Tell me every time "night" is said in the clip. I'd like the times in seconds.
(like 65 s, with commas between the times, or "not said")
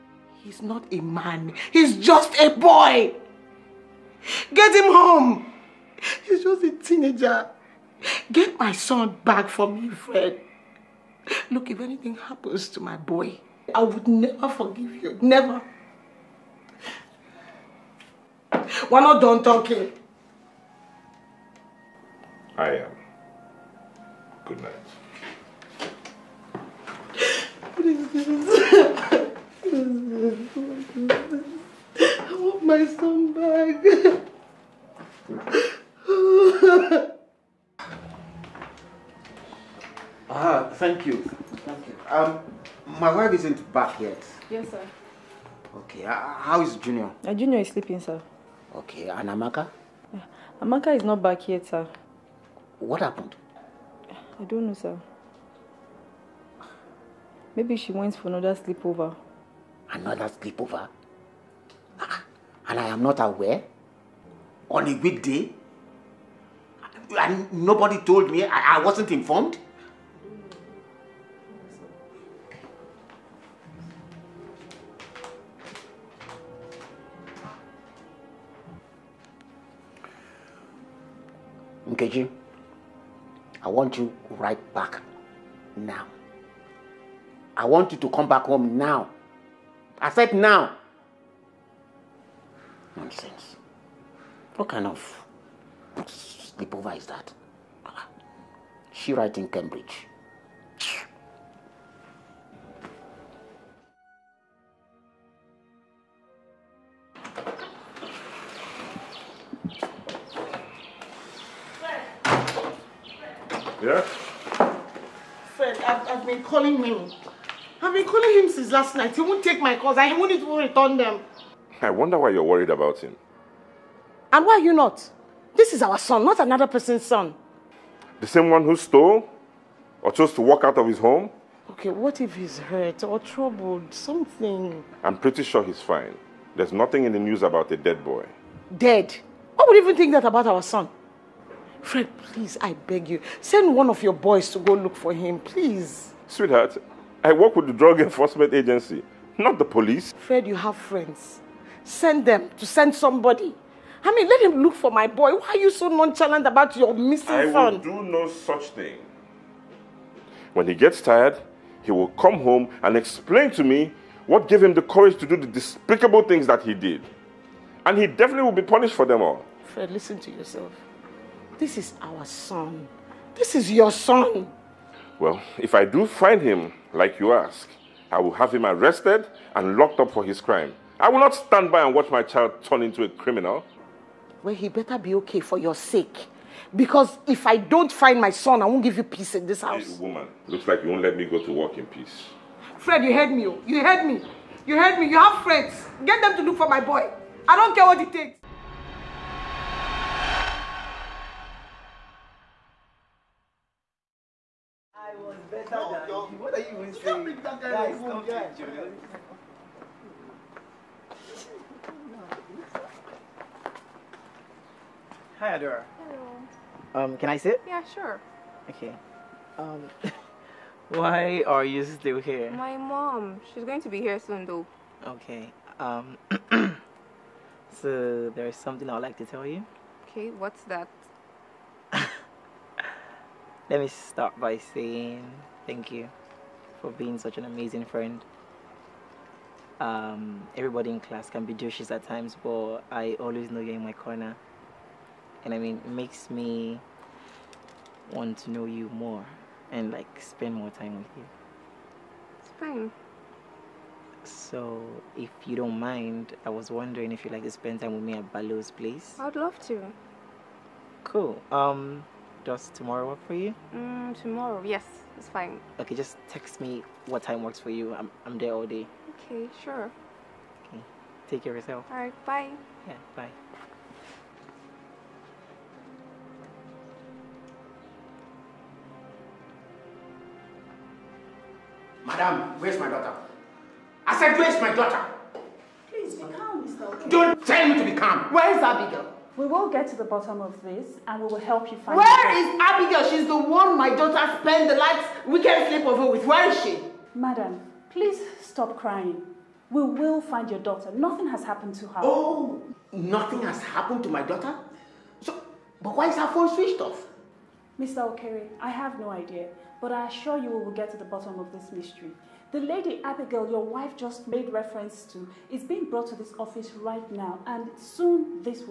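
24 s, 118 s.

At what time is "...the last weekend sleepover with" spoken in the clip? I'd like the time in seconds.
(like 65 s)
294 s.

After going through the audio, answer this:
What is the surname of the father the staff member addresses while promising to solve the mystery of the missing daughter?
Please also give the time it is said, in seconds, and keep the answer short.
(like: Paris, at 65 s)
Okere, at 308 s.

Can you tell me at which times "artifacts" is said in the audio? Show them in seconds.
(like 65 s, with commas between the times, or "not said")
not said.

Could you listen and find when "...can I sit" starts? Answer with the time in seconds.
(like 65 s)
217 s.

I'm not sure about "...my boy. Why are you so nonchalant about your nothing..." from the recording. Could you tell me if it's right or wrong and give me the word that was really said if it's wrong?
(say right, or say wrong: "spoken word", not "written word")
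wrong: "missing", not "nothing".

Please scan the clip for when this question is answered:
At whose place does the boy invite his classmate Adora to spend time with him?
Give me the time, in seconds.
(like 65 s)
258 s.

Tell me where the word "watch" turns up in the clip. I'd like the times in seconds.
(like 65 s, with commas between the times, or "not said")
181 s.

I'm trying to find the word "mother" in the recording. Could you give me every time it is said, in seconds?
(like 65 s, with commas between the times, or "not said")
not said.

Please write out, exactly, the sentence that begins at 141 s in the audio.
Fred, please, I beg you, send one of your boys to go look for him, please.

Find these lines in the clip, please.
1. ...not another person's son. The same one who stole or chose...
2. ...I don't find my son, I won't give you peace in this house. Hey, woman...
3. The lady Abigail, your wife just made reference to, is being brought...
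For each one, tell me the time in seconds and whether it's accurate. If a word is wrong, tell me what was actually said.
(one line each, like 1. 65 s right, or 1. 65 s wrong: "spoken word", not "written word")
1. 126 s right
2. 187 s right
3. 312 s right.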